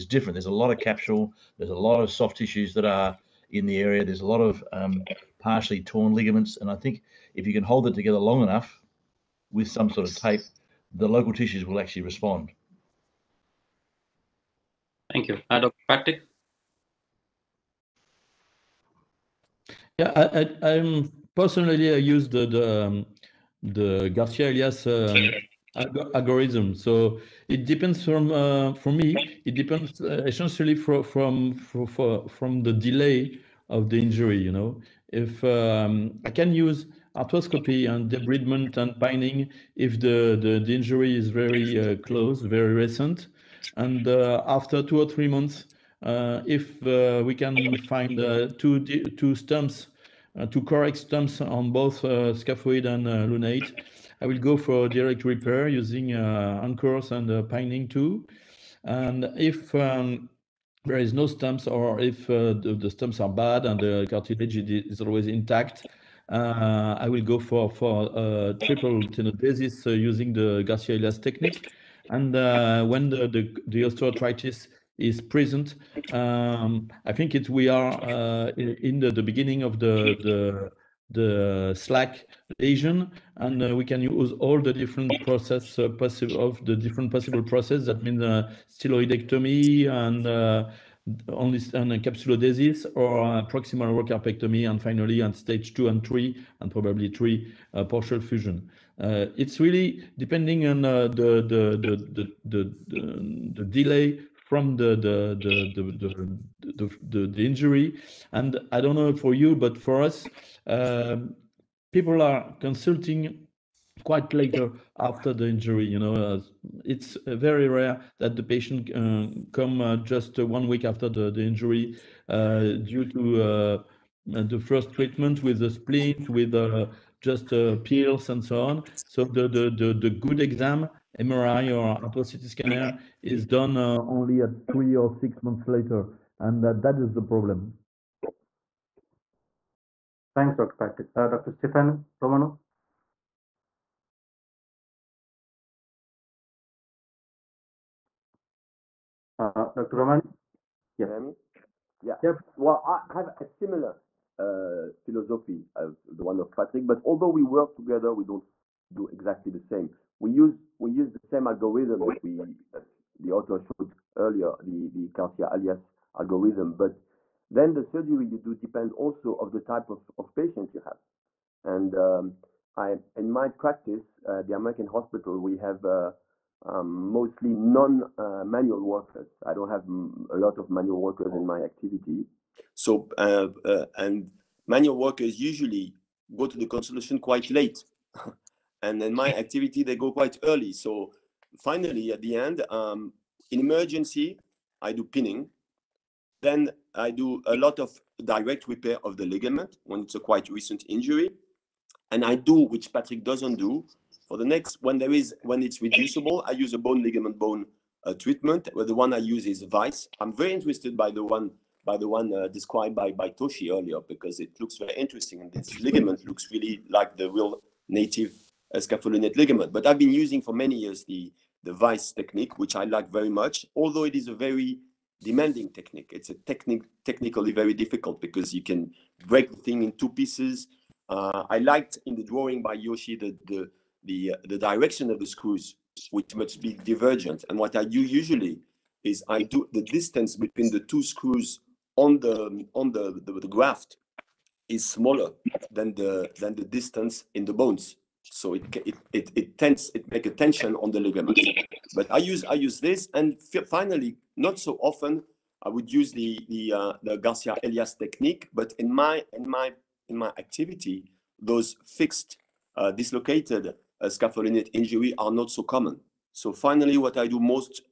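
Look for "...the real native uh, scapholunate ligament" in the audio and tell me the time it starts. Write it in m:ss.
3:37.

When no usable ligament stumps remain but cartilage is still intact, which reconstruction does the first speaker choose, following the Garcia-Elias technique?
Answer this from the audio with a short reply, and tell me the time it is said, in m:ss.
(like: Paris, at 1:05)
triple tenodesis, at 1:08.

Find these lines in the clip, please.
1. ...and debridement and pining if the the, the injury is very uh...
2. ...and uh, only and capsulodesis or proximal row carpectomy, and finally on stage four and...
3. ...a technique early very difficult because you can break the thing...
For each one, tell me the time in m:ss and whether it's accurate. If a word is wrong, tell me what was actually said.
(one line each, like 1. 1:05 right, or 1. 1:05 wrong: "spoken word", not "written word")
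1. 0:37 right
2. 1:29 wrong: "two", not "four"
3. 3:46 wrong: "technically", not "early".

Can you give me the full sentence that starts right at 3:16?
Then I do a lot of direct repair of the ligament when it's a quite recent injury.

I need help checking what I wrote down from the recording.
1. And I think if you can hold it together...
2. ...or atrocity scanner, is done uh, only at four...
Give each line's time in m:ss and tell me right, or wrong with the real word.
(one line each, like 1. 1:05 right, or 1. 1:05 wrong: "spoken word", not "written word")
1. 0:06 right
2. 2:11 wrong: "three", not "four".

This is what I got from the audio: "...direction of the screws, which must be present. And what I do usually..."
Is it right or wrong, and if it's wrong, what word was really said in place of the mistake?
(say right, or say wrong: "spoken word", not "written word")
wrong: "divergent", not "present".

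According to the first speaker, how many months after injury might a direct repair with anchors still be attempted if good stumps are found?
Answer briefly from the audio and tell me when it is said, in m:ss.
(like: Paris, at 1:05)
two or three months, at 0:44.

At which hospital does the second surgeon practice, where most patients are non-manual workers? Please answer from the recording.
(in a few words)
the American hospital.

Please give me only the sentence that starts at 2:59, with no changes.
I don't have a lot of manual workers in my activity.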